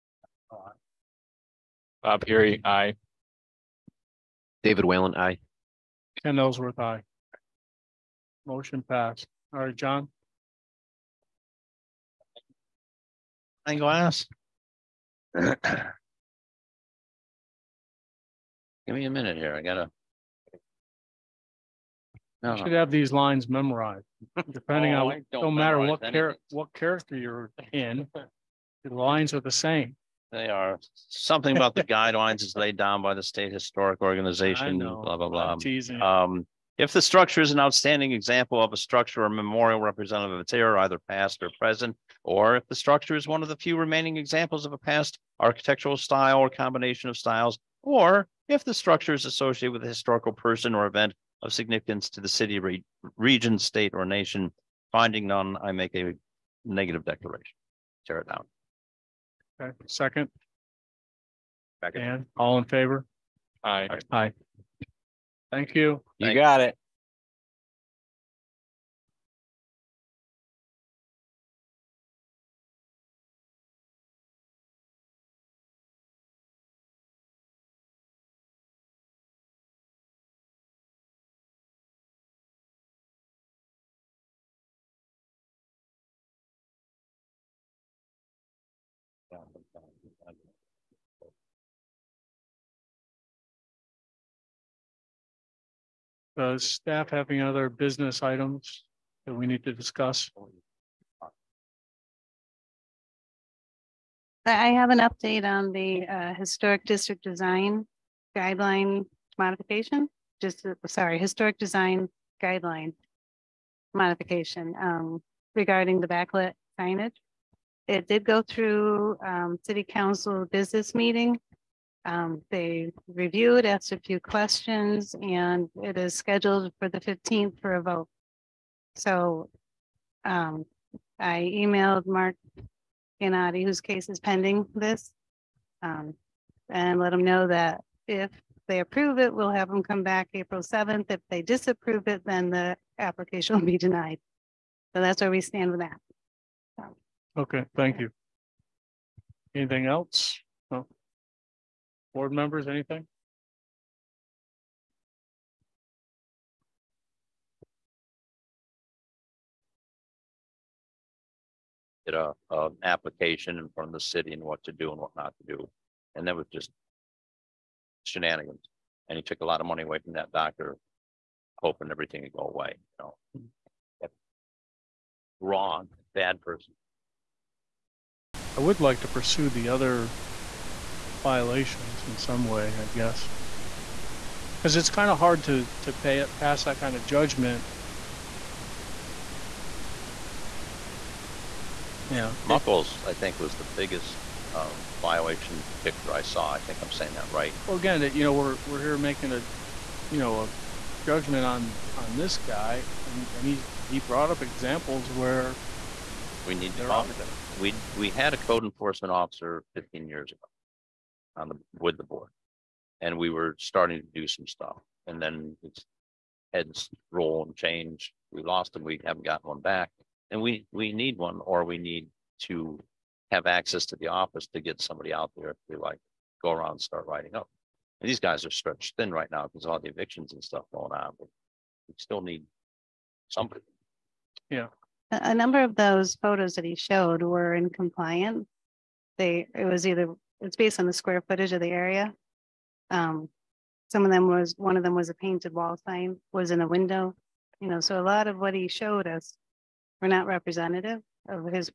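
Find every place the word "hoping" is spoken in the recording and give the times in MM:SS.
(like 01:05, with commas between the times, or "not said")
02:51.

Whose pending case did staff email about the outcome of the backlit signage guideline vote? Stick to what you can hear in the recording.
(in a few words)
Mark Gennady.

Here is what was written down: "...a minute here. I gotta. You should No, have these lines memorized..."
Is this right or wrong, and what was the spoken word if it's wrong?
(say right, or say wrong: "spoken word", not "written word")
right.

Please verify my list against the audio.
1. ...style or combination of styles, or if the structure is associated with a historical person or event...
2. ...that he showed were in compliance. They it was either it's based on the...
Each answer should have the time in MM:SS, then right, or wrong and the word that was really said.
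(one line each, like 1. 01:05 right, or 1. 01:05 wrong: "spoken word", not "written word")
1. 00:45 right
2. 03:56 right.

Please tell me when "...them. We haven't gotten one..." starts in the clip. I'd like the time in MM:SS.
03:38.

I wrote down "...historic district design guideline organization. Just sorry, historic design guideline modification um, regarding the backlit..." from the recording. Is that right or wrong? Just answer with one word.
wrong.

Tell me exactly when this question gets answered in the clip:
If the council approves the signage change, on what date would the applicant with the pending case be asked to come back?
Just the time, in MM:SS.
02:20.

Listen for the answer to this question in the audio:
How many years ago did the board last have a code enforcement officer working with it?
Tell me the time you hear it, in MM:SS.
03:29.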